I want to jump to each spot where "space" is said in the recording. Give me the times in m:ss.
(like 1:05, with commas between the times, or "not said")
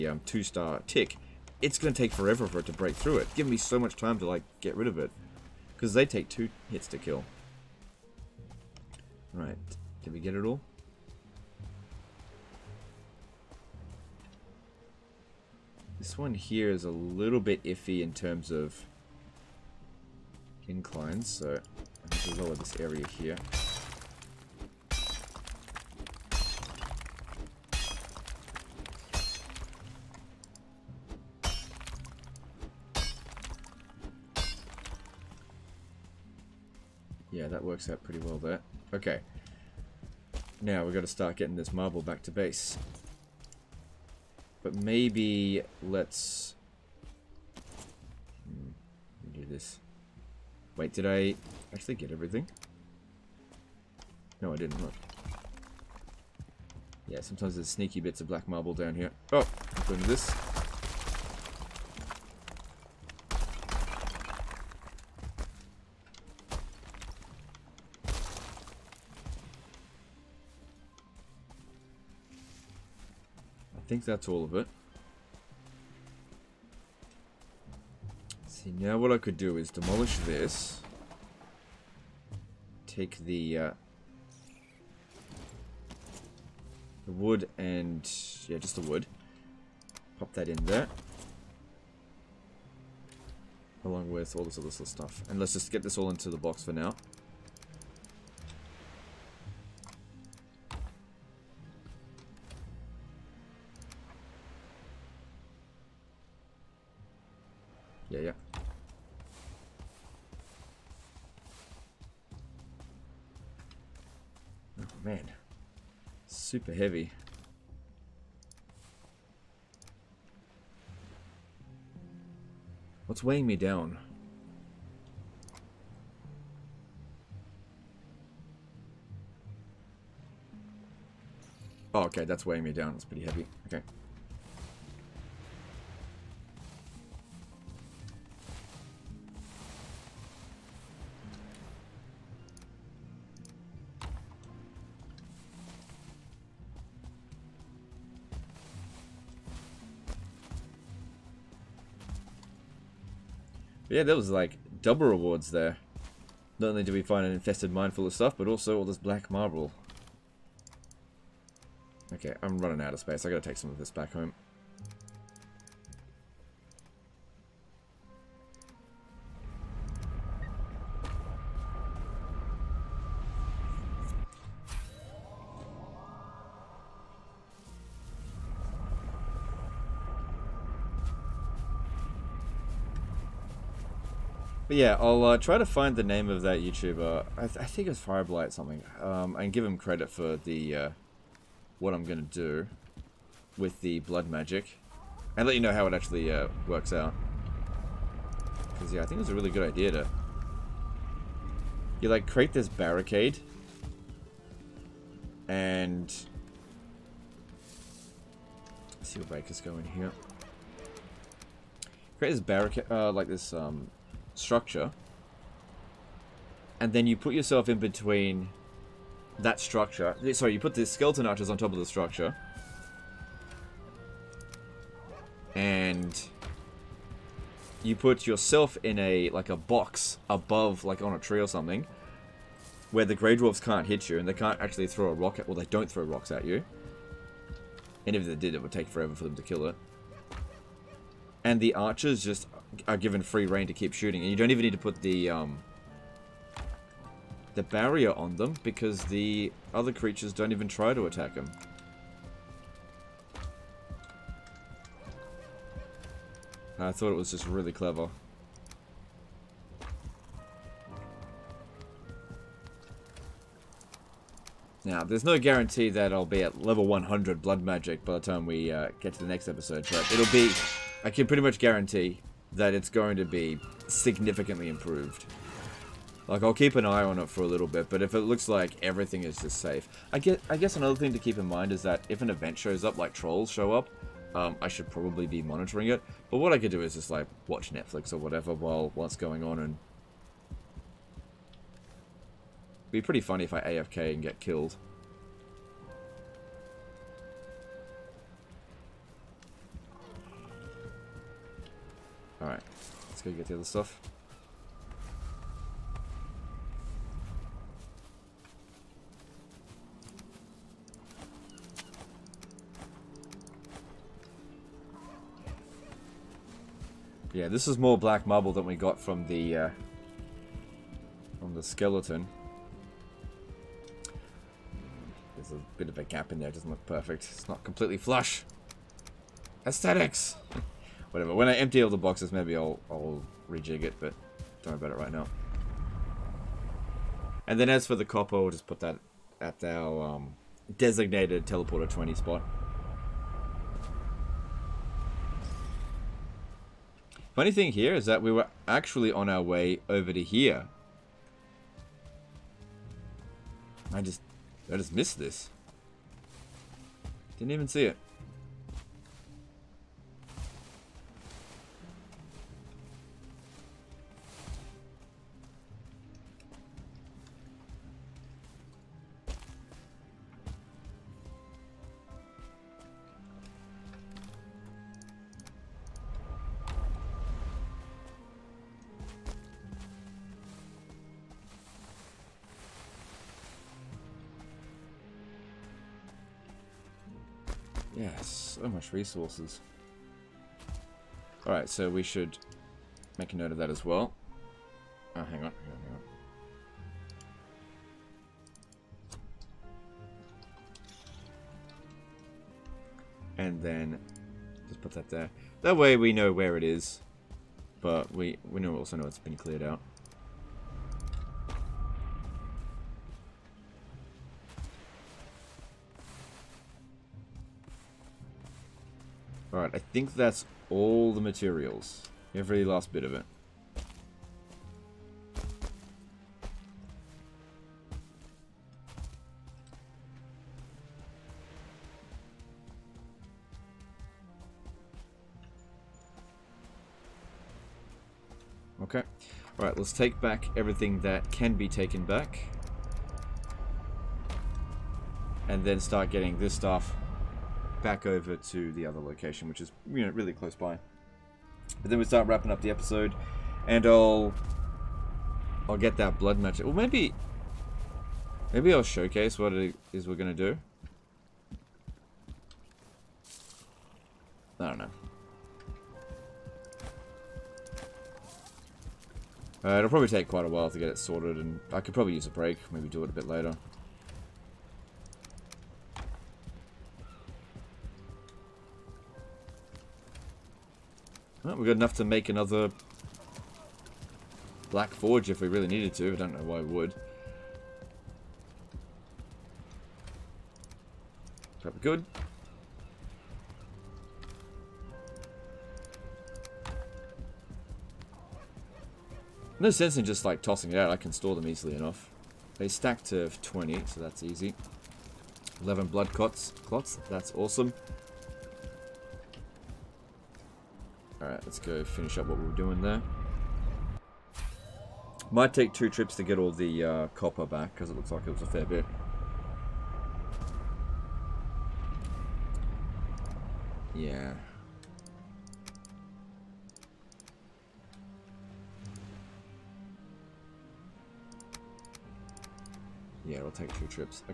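2:42.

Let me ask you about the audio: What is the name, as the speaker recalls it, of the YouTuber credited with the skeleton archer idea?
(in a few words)
Fireblight.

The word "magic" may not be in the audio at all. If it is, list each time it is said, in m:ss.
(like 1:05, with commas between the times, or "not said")
3:14, 4:27.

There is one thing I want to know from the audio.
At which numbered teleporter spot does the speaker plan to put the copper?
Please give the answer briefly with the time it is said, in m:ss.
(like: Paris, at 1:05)
20, at 5:41.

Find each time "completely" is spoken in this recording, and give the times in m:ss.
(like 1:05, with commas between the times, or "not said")
5:27.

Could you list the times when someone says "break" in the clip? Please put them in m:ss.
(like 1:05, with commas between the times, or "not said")
0:02, 7:52.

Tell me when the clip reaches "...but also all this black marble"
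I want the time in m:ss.
2:38.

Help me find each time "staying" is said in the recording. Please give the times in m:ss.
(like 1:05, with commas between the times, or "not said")
not said.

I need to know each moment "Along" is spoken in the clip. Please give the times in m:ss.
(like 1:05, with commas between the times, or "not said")
1:33.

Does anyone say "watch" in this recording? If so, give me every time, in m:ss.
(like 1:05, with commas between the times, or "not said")
4:47.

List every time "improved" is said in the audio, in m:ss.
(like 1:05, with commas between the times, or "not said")
4:34.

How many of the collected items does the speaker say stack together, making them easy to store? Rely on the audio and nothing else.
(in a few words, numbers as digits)
20.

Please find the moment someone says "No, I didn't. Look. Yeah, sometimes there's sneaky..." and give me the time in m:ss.
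0:54.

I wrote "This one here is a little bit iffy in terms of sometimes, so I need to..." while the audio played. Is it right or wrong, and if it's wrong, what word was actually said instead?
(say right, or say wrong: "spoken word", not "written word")
wrong: "inclines", not "sometimes".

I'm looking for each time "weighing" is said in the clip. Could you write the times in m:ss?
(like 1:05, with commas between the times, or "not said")
2:03, 2:12.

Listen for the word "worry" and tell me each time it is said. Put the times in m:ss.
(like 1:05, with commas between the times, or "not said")
5:34.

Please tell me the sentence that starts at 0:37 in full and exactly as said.
Yeah, that works out pretty well there.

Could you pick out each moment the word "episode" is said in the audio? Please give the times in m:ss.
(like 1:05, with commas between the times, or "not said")
4:29, 7:32.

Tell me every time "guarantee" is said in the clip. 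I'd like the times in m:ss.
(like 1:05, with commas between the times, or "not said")
4:25, 4:31.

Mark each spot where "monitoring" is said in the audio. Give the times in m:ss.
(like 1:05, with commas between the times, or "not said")
4:45.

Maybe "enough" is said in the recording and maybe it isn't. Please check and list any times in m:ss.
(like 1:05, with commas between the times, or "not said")
8:01, 8:21.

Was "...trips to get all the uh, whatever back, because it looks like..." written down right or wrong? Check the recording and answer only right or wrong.
wrong.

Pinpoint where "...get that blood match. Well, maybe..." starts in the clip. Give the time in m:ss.
7:35.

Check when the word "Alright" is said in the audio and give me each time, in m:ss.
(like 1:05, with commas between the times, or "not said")
5:02, 6:31, 7:19, 8:31.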